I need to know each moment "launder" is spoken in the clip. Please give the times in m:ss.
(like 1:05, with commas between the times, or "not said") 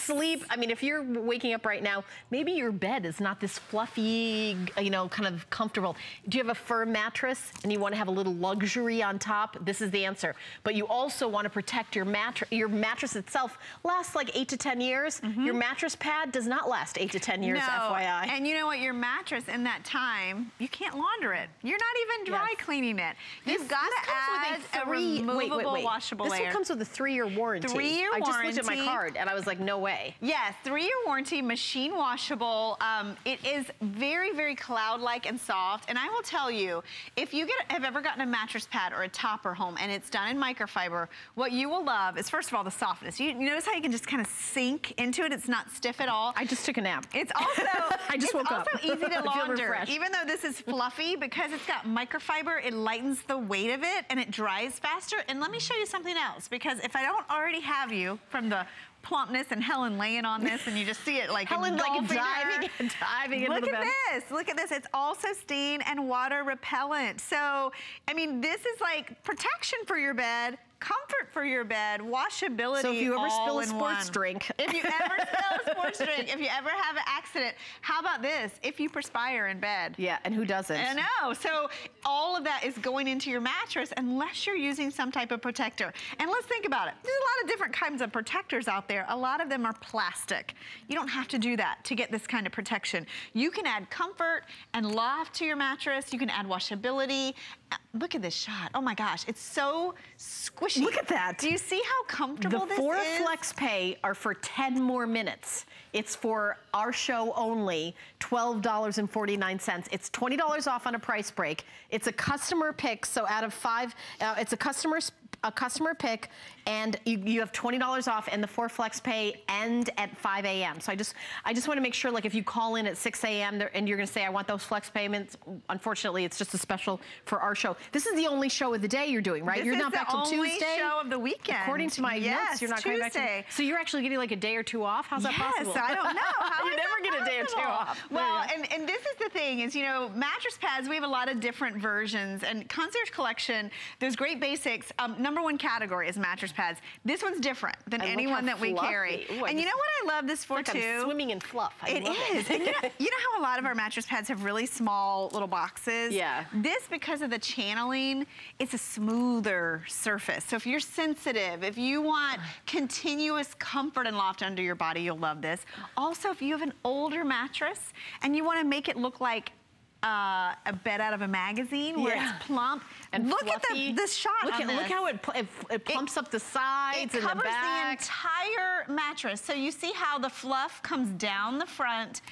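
0:21, 0:49.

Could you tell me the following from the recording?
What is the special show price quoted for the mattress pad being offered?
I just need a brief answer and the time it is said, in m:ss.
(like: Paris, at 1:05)
$12.49, at 1:48.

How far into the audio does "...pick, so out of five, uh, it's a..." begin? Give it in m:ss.
1:52.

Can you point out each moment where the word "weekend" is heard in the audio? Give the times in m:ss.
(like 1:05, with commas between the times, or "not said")
2:11.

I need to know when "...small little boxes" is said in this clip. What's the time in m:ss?
2:34.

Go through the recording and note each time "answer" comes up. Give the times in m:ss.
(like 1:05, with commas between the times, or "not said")
0:10.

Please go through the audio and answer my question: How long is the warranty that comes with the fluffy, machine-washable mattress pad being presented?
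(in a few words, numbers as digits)
3 years.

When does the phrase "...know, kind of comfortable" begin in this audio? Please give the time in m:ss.
0:04.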